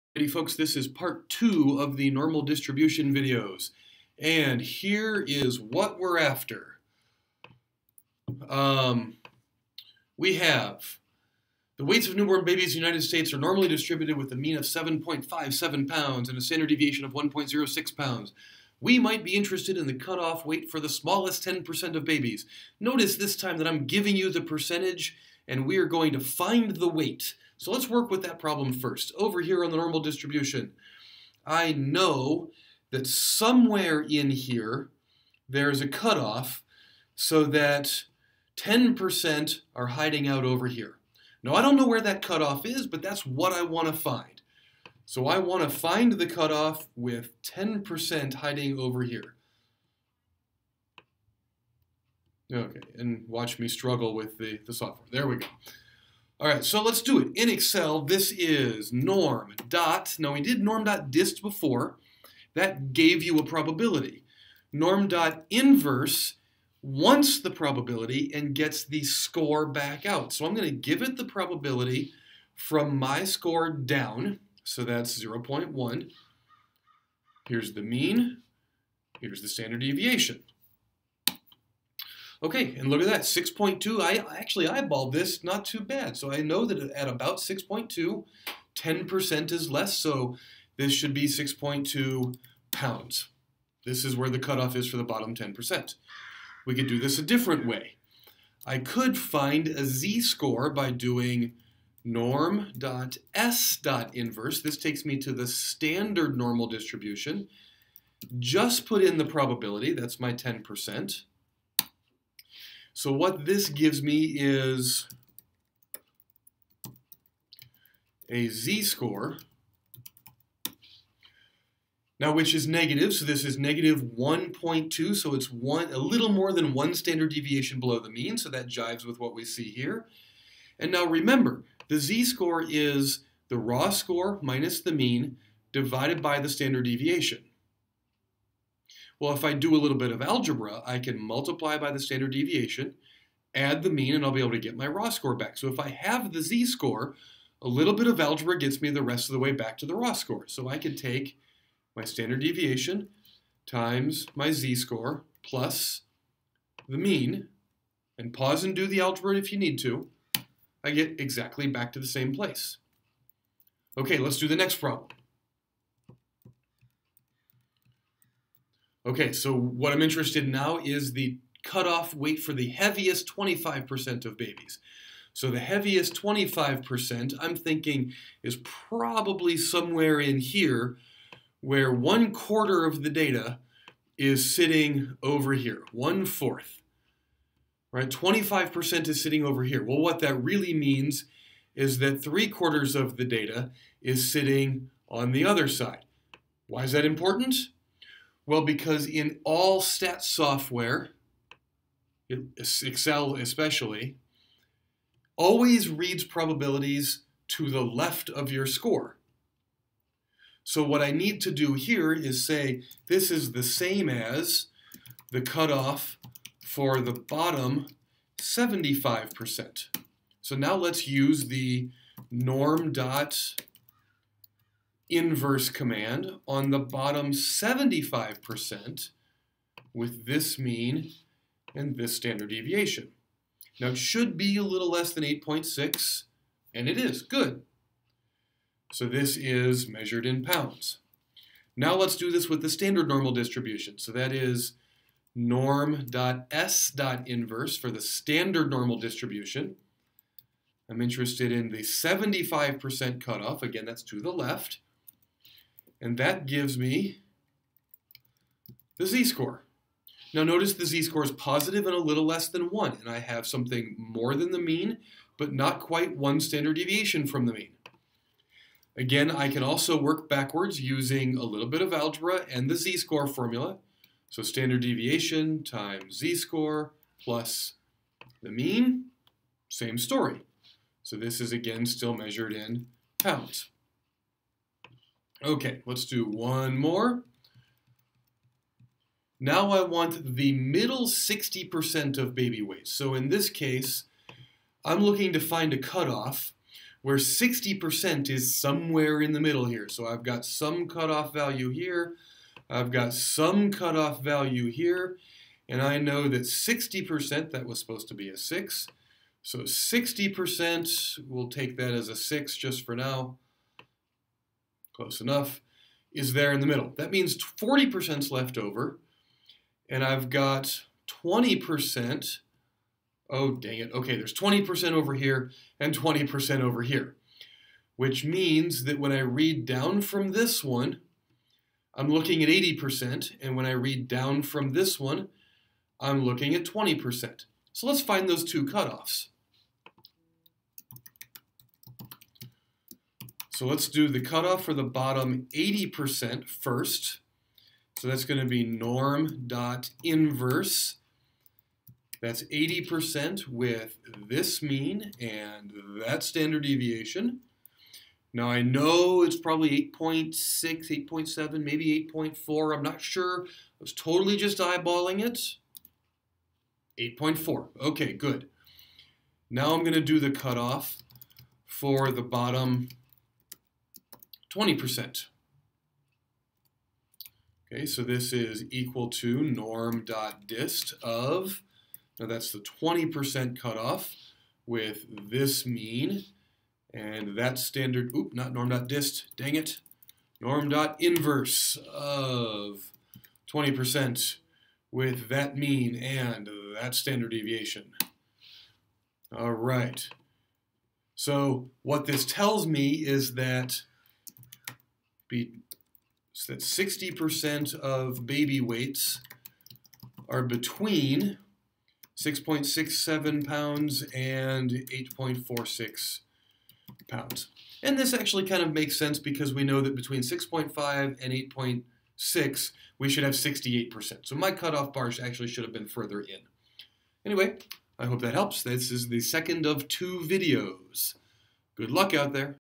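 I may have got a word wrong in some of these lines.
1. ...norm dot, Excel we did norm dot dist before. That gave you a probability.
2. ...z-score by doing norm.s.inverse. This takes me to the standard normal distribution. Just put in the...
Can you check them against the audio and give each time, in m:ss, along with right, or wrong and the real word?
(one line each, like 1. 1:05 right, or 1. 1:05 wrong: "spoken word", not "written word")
1. 0:58 wrong: "Now", not "Excel"
2. 1:39 right.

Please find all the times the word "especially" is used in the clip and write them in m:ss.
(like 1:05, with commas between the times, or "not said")
3:23.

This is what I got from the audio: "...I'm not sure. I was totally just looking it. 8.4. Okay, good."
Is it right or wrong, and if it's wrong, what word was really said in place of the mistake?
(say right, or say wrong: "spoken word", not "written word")
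wrong: "eyeballing", not "looking".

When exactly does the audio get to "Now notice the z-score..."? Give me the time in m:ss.
4:20.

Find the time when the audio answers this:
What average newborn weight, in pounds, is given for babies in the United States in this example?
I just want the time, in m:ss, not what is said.
0:14.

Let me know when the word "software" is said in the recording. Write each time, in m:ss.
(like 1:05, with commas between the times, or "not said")
0:54, 3:20.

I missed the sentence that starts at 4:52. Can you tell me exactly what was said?
So in this case, I'm looking to find a cutoff where 60% is somewhere in the middle here.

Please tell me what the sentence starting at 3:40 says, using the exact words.
So now let's use the norm dot inverse command on the bottom 75% with this mean and this standard deviation.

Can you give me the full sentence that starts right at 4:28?
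Again, I can also work backwards using a little bit of algebra and the z-score formula.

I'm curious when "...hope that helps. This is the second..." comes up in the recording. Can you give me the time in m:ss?
7:08.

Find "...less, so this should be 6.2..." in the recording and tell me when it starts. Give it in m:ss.
1:29.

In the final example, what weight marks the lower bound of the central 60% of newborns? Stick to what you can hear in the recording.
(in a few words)
6.67 pounds.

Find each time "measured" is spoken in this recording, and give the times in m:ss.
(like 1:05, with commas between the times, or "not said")
3:59, 4:42.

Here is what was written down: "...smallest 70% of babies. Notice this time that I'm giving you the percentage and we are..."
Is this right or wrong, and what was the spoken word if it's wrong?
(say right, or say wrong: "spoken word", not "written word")
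wrong: "10", not "70".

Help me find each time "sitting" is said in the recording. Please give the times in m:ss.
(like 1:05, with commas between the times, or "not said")
3:04, 3:09, 3:14.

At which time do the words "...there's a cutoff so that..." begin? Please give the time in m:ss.
0:35.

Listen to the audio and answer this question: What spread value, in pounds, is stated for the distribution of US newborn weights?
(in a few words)
1.06 pounds.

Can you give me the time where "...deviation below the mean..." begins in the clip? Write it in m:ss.
2:07.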